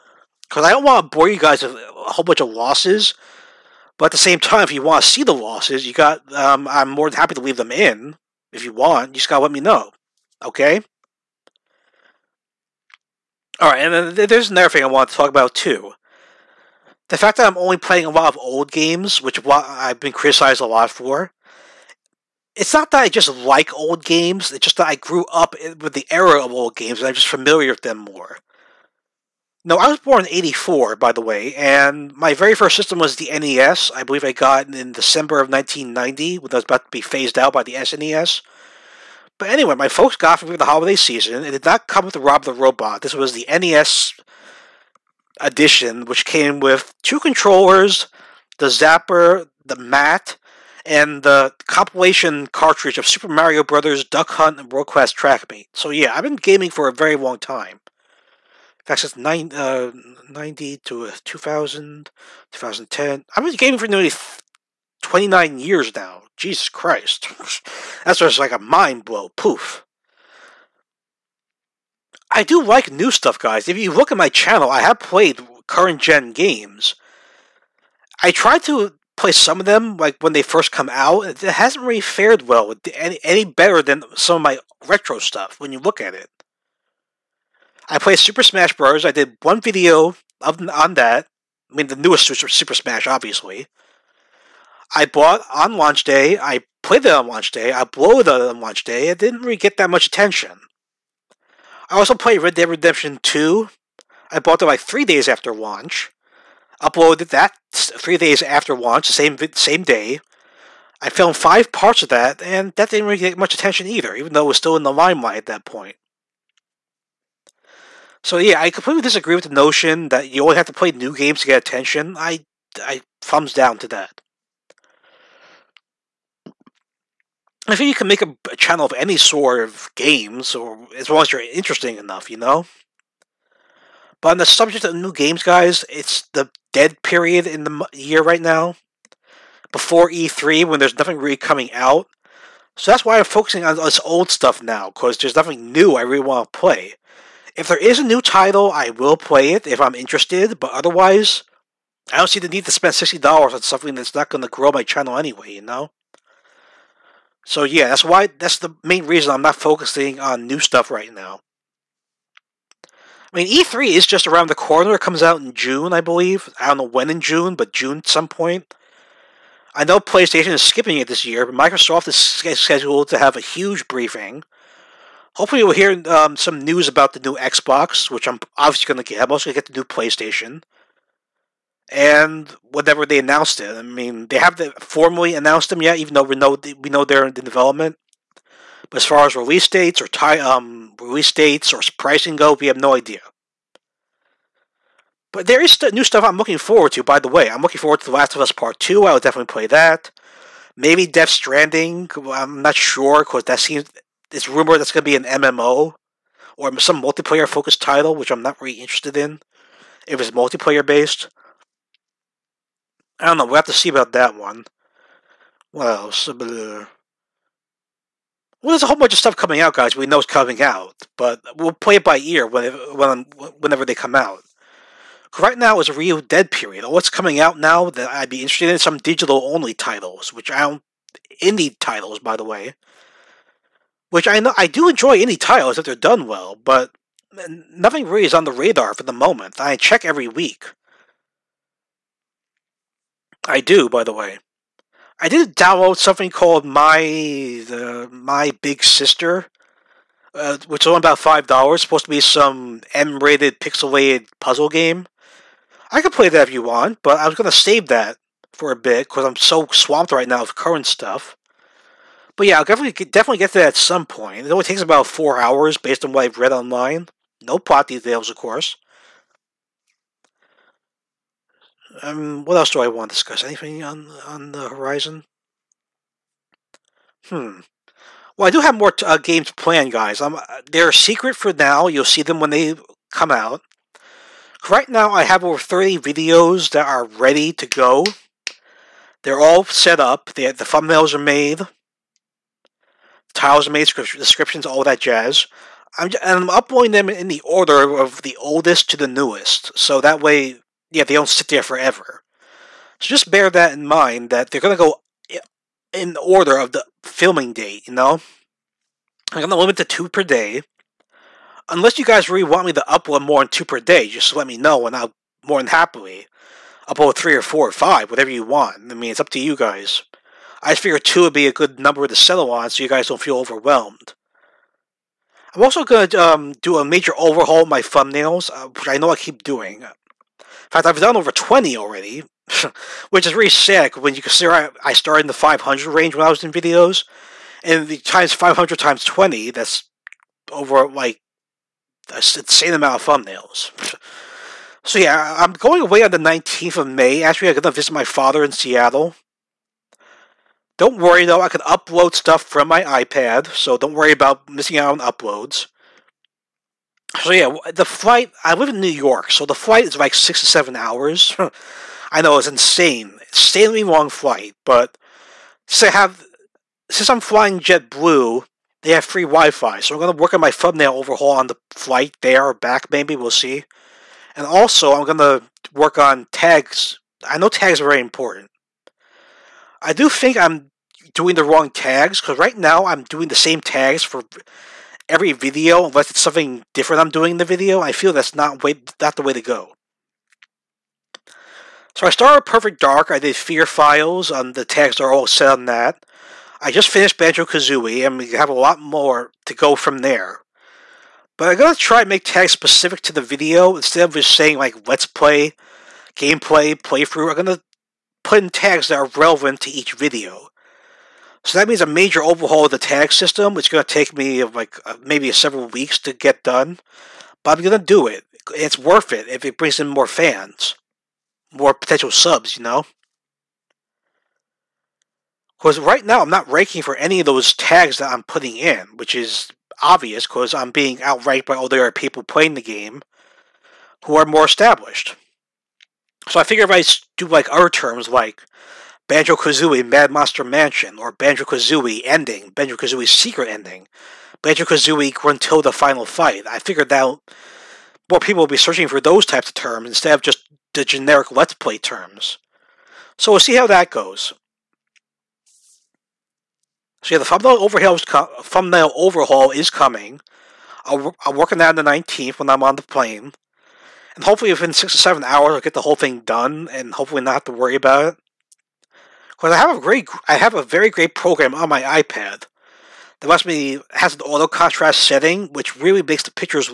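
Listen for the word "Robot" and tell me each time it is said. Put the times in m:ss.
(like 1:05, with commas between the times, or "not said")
0:42.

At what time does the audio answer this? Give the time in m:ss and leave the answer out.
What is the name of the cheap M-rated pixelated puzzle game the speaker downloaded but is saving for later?
4:08.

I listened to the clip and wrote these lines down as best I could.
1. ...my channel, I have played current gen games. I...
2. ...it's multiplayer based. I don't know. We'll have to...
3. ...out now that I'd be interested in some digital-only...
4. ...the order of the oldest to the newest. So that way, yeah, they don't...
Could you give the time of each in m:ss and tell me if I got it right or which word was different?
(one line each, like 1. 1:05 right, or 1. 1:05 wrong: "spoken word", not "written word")
1. 1:14 right
2. 3:30 right
3. 3:47 right
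4. 4:57 right.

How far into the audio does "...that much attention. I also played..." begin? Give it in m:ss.
1:39.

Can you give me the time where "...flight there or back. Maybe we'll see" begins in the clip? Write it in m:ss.
6:11.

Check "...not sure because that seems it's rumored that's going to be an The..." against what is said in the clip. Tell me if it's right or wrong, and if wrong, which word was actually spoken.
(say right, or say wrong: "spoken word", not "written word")
wrong: "MMO", not "The".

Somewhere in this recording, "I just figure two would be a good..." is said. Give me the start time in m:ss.
5:20.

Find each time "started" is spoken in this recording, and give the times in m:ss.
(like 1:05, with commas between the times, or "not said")
5:34, 6:32.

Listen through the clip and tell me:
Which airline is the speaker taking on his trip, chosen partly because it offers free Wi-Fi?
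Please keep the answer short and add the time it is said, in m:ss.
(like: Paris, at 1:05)
JetBlue, at 6:07.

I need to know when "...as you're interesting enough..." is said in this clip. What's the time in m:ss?
2:11.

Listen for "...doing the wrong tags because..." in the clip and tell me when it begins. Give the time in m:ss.
6:21.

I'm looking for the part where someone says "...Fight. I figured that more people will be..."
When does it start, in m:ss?
7:26.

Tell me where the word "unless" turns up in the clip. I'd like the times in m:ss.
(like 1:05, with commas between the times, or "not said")
5:11, 6:25.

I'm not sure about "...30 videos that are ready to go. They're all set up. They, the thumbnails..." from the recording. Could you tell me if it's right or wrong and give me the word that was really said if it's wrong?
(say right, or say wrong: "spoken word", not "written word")
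right.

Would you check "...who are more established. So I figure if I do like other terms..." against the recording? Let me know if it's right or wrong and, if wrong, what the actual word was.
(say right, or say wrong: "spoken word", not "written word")
right.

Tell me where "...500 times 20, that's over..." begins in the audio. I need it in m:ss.
5:38.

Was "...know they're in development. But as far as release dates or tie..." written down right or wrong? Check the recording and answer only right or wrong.
right.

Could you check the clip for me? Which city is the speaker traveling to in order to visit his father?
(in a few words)
Seattle.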